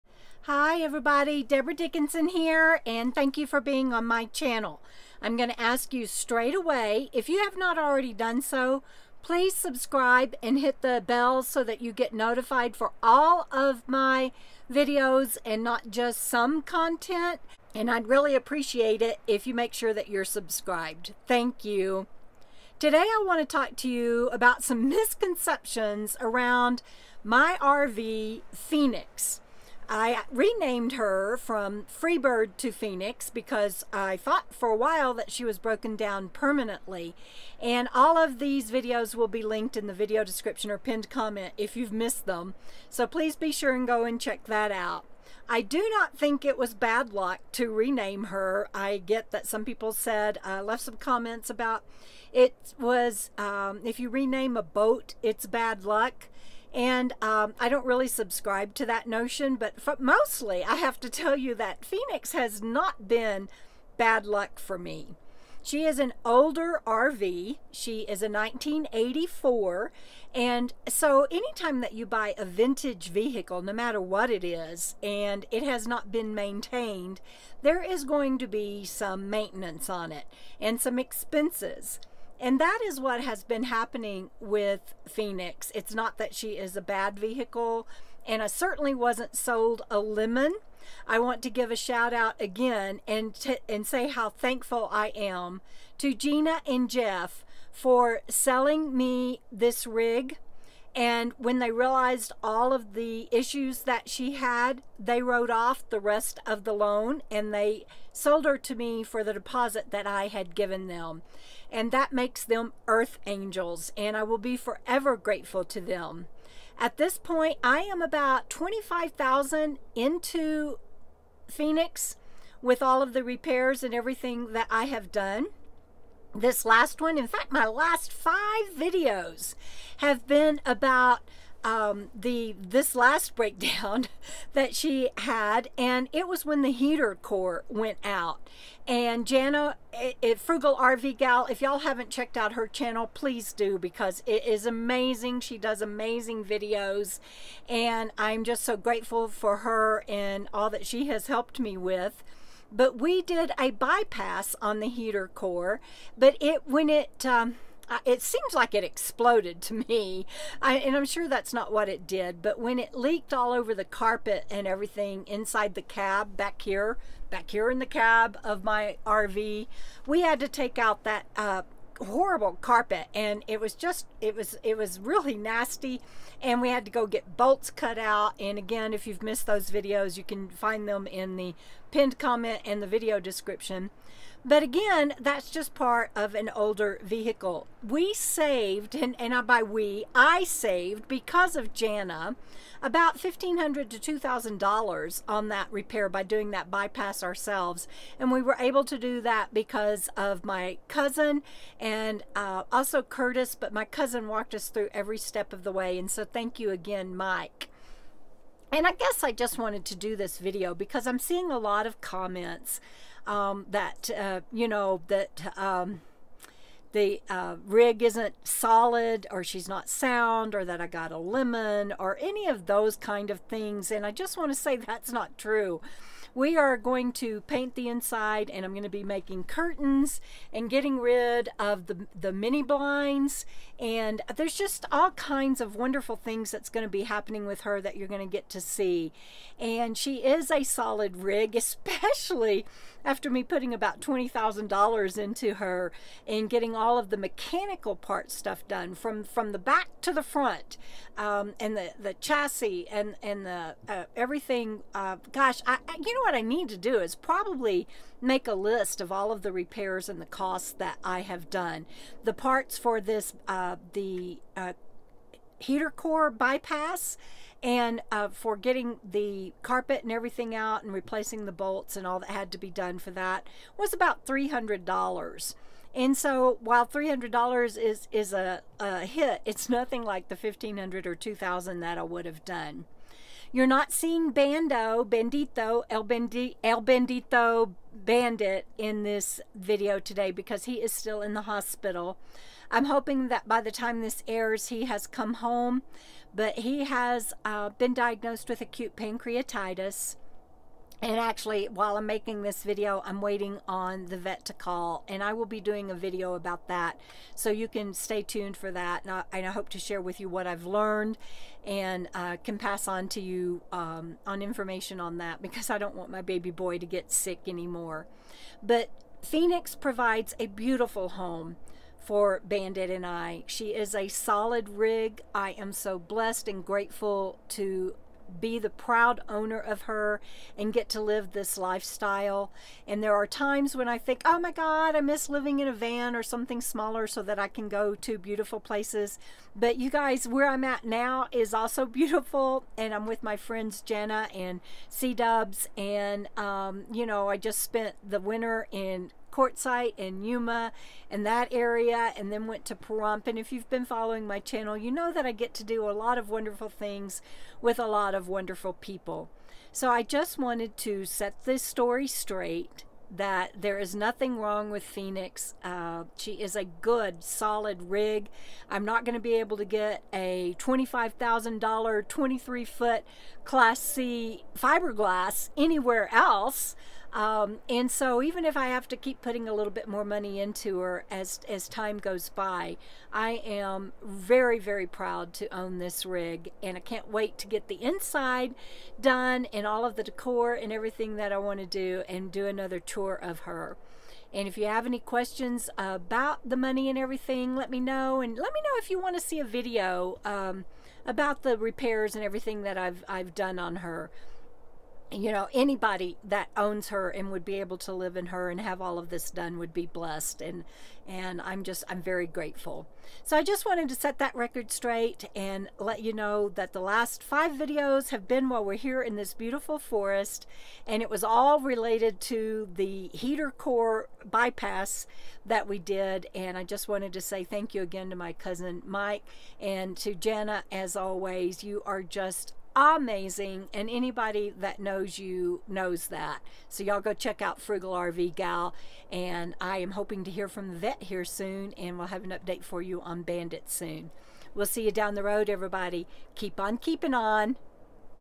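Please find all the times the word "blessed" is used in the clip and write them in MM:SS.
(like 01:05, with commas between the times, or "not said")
05:25, 06:49.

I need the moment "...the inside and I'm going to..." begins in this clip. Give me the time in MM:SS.
03:47.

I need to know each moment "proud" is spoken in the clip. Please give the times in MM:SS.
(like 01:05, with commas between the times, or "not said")
05:28, 06:24.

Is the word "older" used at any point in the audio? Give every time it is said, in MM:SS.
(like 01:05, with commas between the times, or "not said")
01:06, 03:06.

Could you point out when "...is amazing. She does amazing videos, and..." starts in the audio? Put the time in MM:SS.
02:24.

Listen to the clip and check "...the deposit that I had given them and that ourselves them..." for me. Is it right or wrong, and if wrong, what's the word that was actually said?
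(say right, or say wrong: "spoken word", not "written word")
wrong: "makes", not "ourselves".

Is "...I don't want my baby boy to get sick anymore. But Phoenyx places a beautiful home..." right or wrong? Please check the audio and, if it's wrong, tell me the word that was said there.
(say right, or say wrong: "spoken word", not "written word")
wrong: "provides", not "places".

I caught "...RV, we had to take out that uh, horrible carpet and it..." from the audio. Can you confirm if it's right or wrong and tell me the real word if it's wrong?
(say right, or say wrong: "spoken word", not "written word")
right.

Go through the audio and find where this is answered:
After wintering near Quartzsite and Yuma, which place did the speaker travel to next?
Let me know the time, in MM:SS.
05:52.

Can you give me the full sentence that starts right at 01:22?
And that is what has been happening with Phoenyx.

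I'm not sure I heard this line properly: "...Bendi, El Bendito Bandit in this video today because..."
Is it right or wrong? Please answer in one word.
right.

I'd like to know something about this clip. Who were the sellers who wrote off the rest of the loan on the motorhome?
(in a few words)
Gina and Jeff.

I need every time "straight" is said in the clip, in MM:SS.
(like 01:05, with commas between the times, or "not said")
00:06, 06:02, 06:54.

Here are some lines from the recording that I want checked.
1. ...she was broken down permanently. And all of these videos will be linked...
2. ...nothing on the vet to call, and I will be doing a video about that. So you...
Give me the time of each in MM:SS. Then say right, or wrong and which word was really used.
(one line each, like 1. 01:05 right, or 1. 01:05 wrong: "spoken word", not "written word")
1. 00:35 right
2. 05:03 wrong: "waiting", not "nothing".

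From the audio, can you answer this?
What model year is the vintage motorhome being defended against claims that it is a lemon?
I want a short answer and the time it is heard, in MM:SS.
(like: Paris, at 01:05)
1984, at 01:08.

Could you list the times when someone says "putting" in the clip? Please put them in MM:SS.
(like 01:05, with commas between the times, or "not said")
04:03, 06:19.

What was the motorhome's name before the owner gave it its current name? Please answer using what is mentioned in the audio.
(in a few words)
Freebird.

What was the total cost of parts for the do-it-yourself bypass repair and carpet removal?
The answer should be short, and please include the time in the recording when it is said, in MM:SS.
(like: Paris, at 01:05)
$300, at 04:34.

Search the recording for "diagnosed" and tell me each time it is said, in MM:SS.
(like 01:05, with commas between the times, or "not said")
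04:57.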